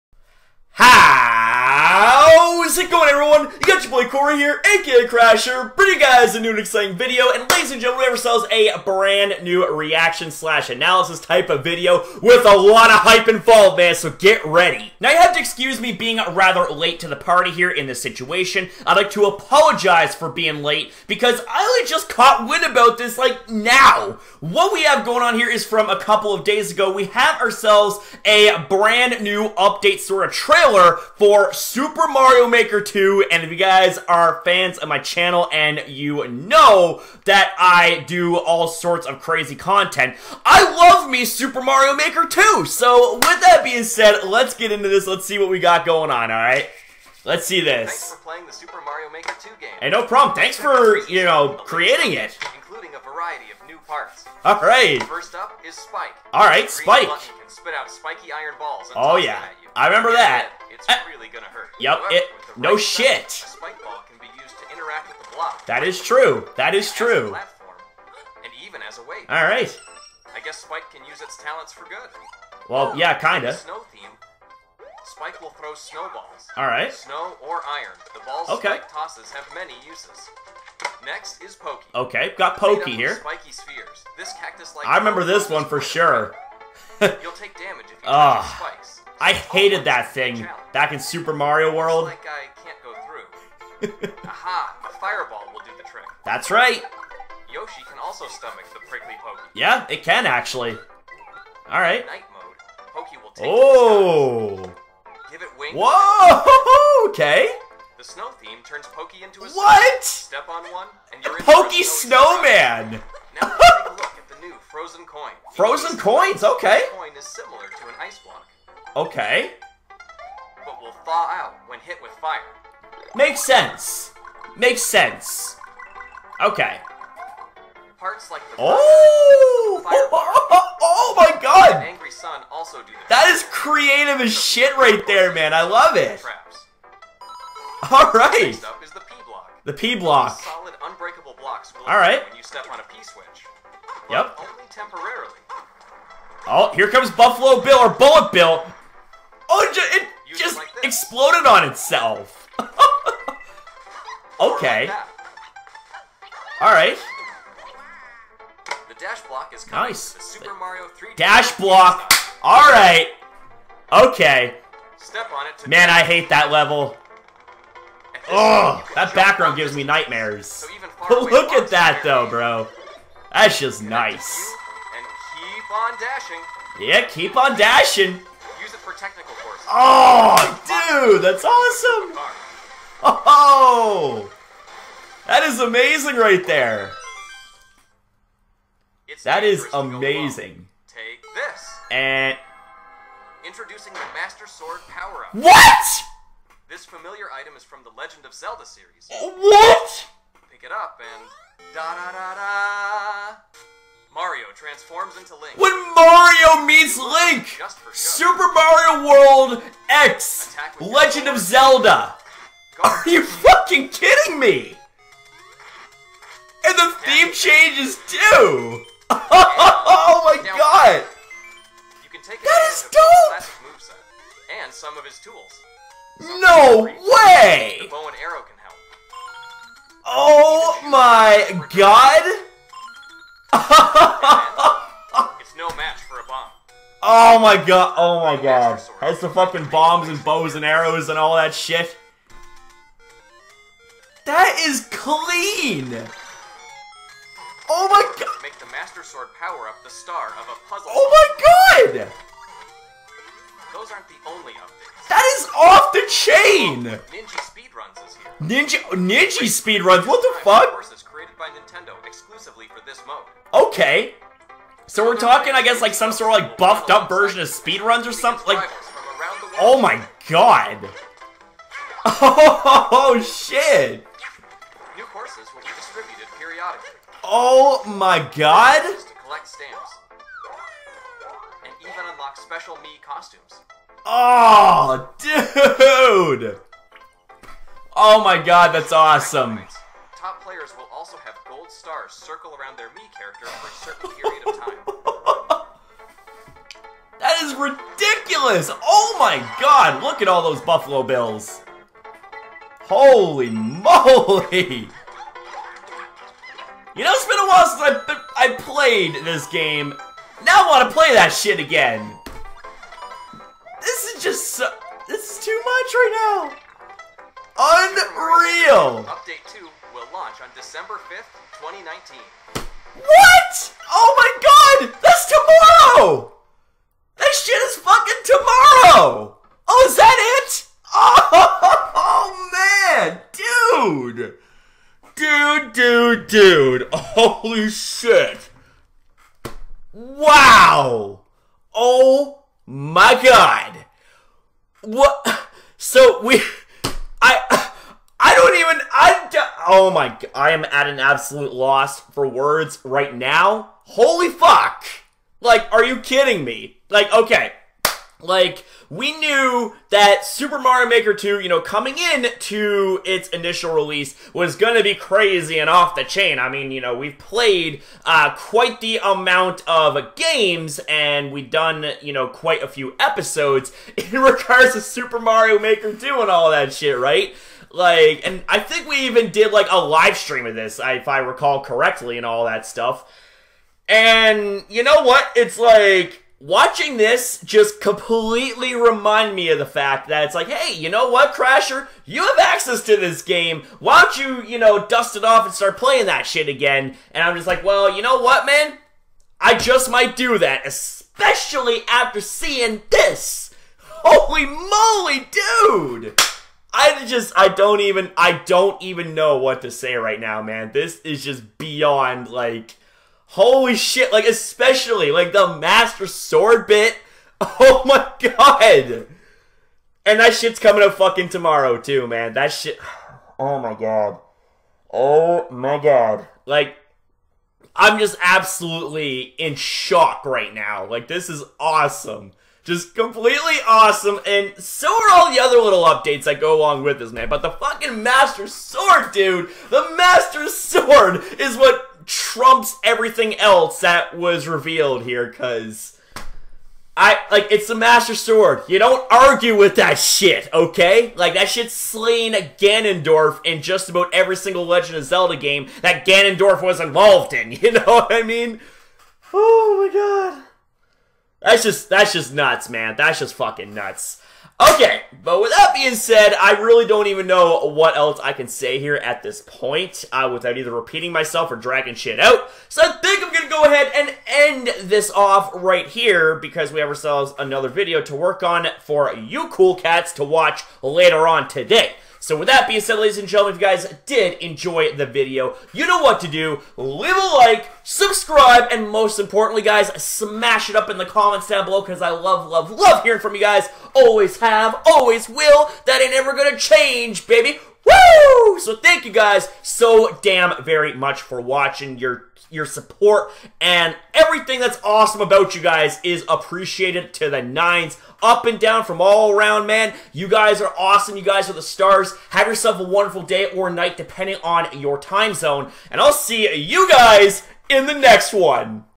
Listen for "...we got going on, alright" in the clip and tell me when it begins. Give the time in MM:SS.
00:45.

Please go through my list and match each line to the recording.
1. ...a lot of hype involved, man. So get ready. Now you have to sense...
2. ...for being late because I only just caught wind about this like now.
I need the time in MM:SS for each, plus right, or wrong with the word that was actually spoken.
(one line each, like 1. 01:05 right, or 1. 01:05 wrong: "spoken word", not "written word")
1. 00:12 wrong: "excuse", not "sense"
2. 00:20 right.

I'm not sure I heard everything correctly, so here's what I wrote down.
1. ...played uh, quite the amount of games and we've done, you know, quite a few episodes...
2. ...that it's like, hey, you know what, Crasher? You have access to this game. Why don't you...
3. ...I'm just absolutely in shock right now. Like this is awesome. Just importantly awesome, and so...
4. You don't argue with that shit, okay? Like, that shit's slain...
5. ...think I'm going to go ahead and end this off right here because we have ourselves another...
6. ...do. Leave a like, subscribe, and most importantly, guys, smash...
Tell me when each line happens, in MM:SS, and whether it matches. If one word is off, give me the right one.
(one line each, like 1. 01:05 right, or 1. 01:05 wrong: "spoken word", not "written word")
1. 06:07 right
2. 06:30 right
3. 07:07 wrong: "completely", not "importantly"
4. 07:28 right
5. 07:52 right
6. 08:06 right.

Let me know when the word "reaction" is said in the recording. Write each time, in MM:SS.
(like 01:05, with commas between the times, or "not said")
00:09.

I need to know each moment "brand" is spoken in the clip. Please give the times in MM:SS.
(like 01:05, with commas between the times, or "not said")
00:08, 00:28.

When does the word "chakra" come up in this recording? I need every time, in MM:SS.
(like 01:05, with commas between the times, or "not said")
not said.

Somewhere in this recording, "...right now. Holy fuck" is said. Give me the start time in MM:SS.
05:52.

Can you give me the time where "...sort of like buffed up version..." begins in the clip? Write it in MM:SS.
04:26.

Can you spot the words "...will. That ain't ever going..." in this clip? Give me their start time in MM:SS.
08:15.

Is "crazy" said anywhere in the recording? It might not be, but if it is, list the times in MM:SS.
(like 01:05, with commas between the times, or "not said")
00:39, 06:04.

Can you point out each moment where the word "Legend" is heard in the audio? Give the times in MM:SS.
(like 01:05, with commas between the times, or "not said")
03:17, 03:30, 07:34.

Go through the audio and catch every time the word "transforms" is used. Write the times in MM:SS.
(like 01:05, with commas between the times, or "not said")
03:24.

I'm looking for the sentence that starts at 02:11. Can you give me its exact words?
An angry sun also do that.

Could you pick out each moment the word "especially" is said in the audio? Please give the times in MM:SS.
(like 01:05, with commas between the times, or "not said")
06:40, 06:54.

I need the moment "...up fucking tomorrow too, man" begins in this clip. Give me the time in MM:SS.
07:00.